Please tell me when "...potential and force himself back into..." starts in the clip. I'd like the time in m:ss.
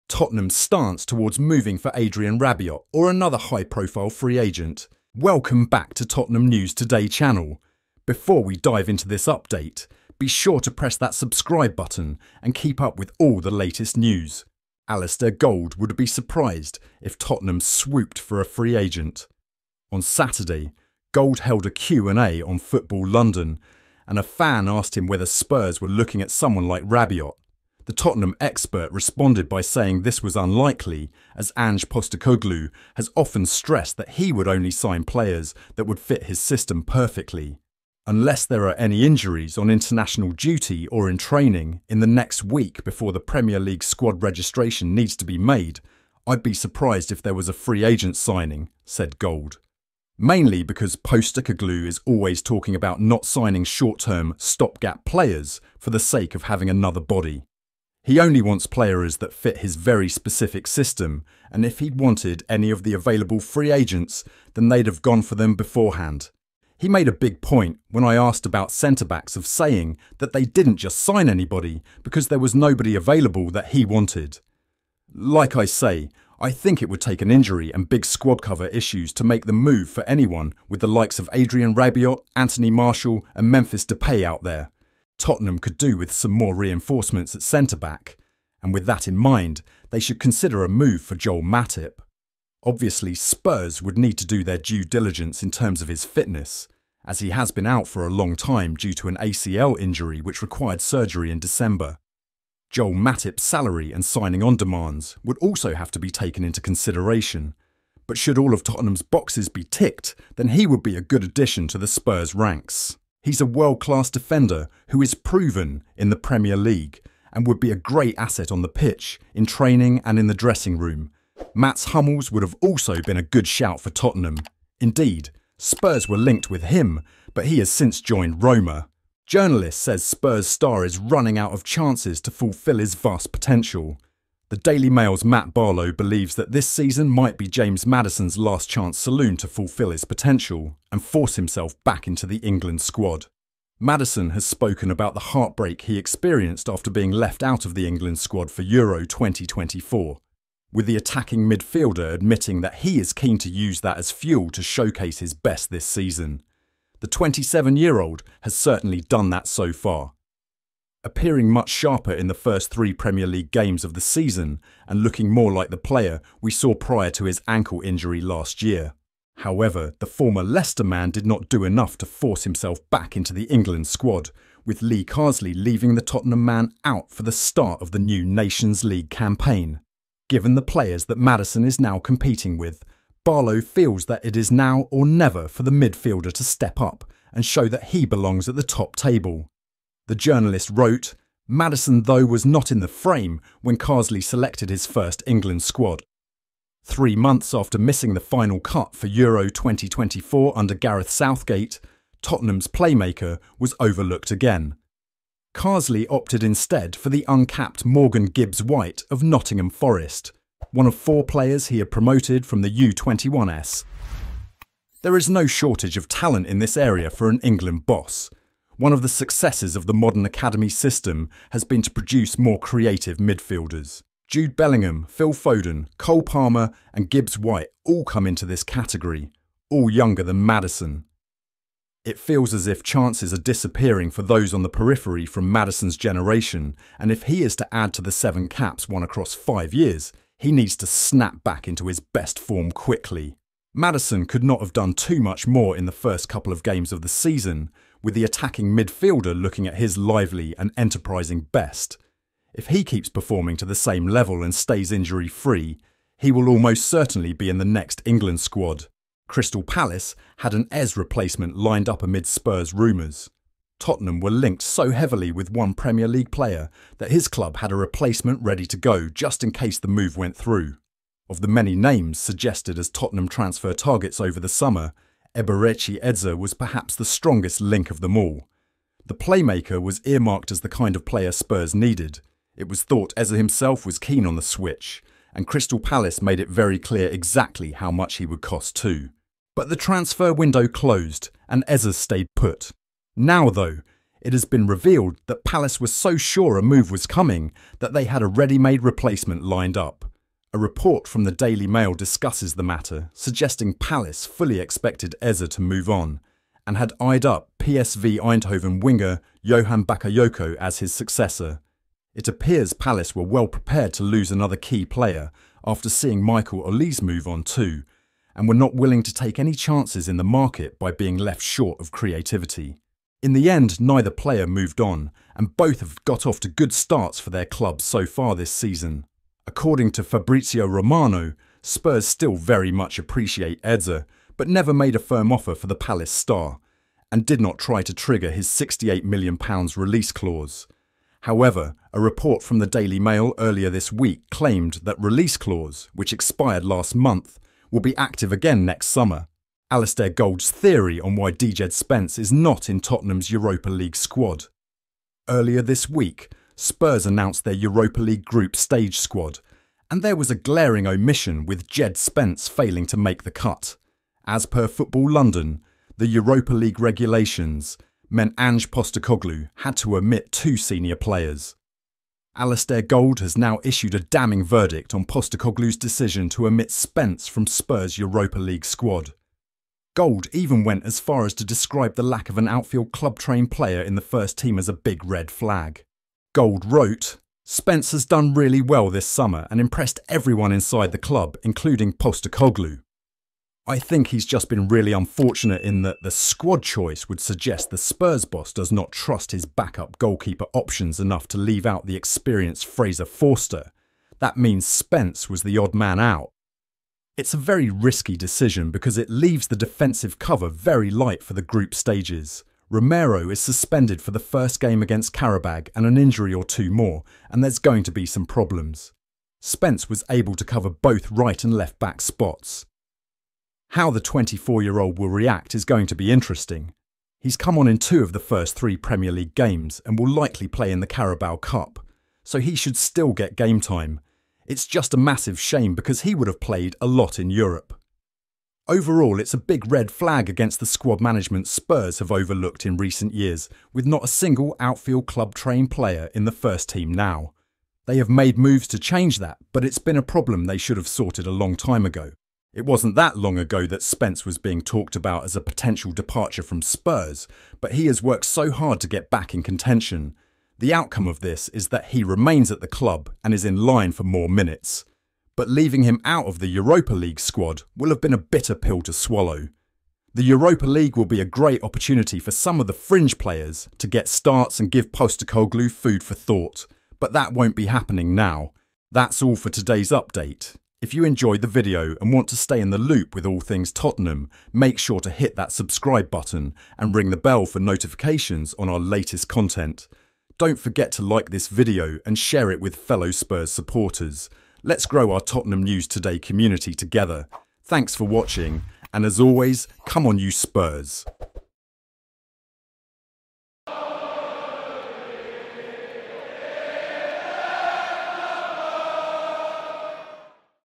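2:20.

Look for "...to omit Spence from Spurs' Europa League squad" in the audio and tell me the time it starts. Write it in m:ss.
6:16.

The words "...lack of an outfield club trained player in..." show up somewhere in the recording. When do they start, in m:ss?
6:22.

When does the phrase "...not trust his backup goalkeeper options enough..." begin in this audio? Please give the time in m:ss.
6:38.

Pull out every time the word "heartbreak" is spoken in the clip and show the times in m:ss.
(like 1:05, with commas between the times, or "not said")
2:25.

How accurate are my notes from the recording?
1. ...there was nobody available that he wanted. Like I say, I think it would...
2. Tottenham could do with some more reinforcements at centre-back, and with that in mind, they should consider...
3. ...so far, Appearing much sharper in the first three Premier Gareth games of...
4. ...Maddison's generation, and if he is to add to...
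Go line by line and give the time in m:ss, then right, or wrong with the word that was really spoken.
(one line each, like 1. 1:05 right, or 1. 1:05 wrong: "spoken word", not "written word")
1. 1:12 right
2. 1:25 right
3. 2:39 wrong: "League", not "Gareth"
4. 3:55 right.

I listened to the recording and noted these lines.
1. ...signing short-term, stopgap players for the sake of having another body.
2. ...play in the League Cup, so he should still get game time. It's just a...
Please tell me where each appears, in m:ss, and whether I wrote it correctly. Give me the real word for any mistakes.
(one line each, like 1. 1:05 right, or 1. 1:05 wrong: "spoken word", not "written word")
1. 0:53 right
2. 7:10 wrong: "Carabao", not "League".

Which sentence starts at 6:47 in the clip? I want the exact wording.
It's a very risky decision because it leaves the defensive cover very light for the group stages.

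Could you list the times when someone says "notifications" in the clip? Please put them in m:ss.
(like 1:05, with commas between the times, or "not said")
8:07.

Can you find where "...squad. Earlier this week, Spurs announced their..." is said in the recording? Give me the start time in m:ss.
5:53.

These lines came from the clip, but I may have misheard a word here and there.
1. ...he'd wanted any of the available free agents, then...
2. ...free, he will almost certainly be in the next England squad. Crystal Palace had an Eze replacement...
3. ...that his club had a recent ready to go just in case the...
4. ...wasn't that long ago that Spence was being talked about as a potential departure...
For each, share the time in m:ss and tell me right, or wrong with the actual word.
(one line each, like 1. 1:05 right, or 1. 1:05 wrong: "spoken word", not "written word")
1. 1:01 right
2. 4:15 right
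3. 4:26 wrong: "replacement", not "recent"
4. 7:32 right.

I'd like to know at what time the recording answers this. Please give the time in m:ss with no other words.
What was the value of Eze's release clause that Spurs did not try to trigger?
5:38.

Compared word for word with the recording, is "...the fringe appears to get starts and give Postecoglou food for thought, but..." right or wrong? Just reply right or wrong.
wrong.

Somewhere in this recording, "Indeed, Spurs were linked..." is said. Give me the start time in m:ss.
2:04.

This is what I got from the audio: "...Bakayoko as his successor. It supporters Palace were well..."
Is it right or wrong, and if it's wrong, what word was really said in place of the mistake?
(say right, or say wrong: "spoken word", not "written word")
wrong: "appears", not "supporters".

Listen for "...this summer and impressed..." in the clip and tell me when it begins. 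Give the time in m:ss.
6:28.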